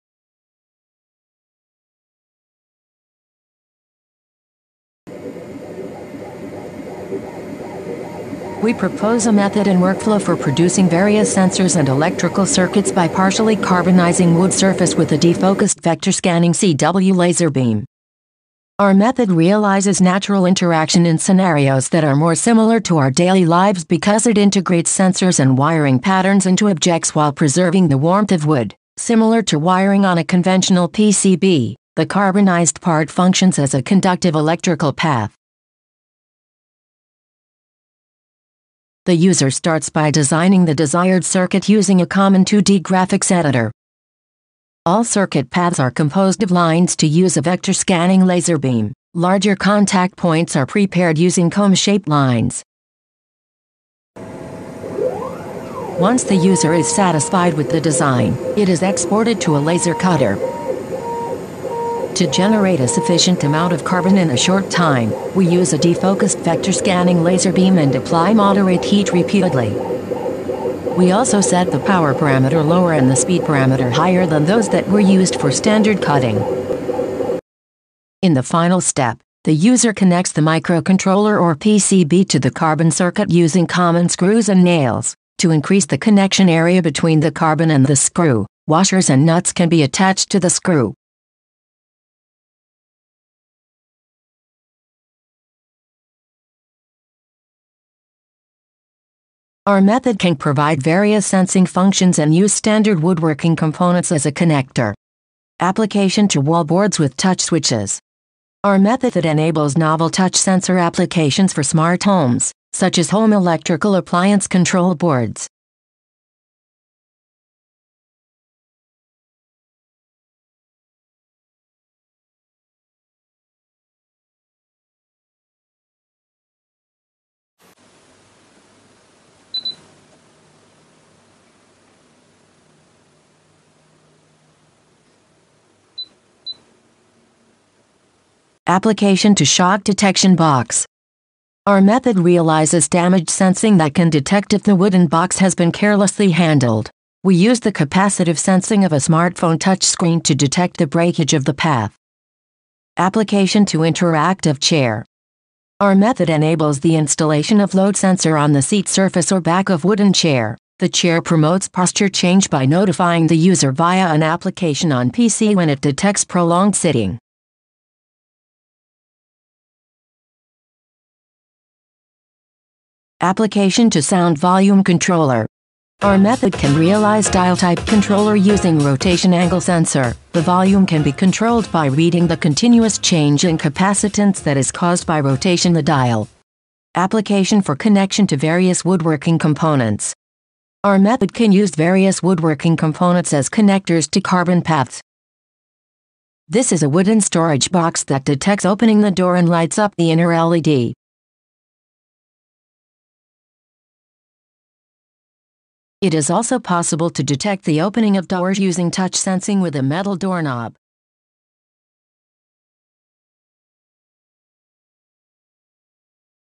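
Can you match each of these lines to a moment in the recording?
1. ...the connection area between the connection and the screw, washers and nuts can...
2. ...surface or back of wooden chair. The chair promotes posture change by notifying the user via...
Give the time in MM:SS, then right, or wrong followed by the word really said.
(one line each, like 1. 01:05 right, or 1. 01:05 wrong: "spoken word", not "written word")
1. 01:25 wrong: "carbon", not "connection"
2. 02:38 right.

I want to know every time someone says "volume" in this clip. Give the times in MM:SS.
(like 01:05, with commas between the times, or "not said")
02:54, 03:00.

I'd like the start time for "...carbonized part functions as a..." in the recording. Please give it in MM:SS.
00:32.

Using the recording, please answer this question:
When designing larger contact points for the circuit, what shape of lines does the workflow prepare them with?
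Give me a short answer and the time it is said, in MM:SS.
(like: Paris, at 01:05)
Comb-shaped lines, at 00:51.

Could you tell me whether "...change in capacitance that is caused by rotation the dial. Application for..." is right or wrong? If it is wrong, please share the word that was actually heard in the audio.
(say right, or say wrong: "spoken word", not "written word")
right.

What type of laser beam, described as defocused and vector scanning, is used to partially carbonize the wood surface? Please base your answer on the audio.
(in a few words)
CW laser beam.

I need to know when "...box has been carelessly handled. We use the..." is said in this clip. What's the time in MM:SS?
02:25.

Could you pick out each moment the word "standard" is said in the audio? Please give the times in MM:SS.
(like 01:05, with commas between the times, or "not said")
01:15, 01:42.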